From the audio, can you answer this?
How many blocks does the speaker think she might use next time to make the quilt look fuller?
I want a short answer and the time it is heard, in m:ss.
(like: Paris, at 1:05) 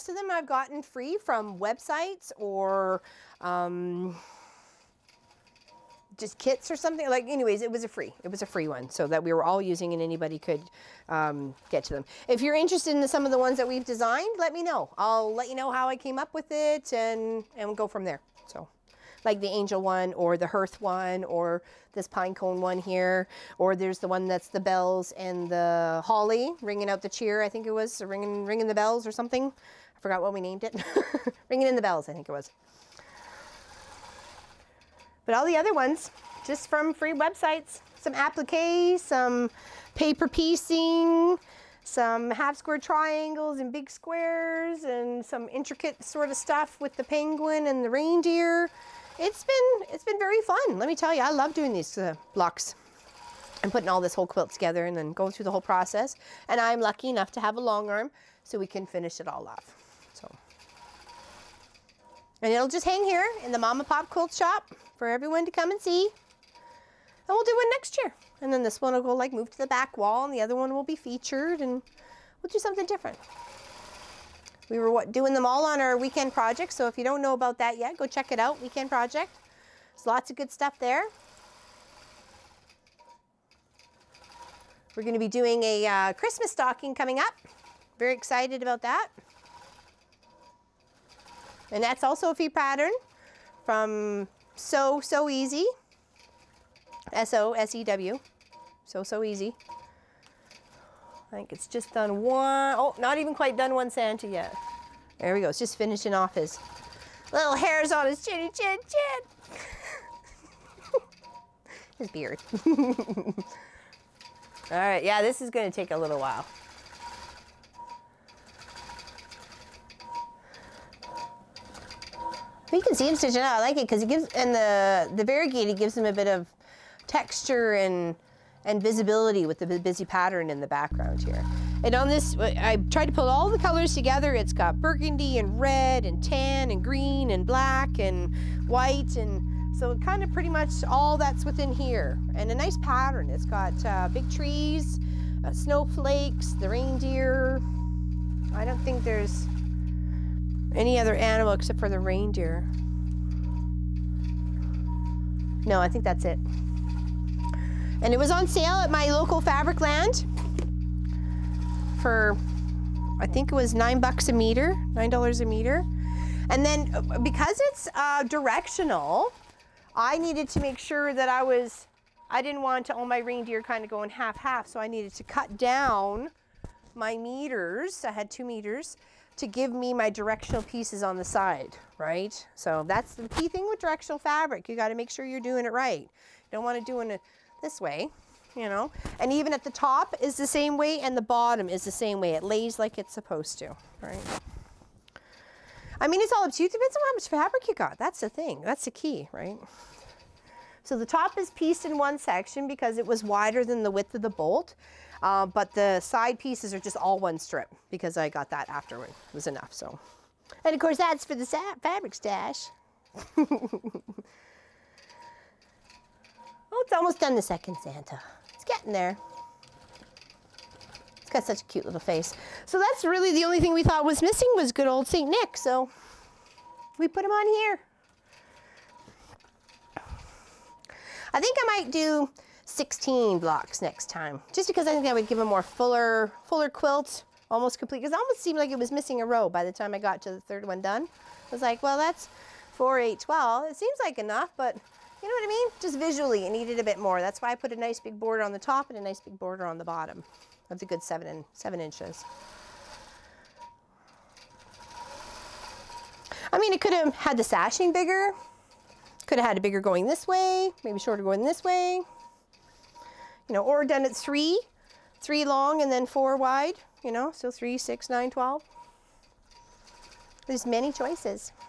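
16, at 3:52.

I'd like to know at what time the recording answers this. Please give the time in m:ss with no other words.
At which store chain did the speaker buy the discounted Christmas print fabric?
2:39.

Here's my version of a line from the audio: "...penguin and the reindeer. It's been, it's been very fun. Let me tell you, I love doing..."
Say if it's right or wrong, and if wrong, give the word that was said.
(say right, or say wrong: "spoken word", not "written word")
right.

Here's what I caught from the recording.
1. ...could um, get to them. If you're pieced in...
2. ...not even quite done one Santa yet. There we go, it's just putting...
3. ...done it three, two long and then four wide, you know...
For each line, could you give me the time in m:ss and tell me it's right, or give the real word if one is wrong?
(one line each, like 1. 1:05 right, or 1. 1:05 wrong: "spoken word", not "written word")
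1. 0:10 wrong: "interested", not "pieced"
2. 1:42 wrong: "finishing", not "putting"
3. 4:23 wrong: "three", not "two".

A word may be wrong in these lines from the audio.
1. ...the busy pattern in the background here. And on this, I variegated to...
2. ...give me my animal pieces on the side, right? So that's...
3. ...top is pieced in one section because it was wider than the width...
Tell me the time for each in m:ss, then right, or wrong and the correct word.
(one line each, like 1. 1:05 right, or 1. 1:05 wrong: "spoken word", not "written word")
1. 2:09 wrong: "tried", not "variegated"
2. 2:59 wrong: "directional", not "animal"
3. 3:21 right.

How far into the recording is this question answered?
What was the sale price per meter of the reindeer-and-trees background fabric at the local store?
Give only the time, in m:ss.
2:44.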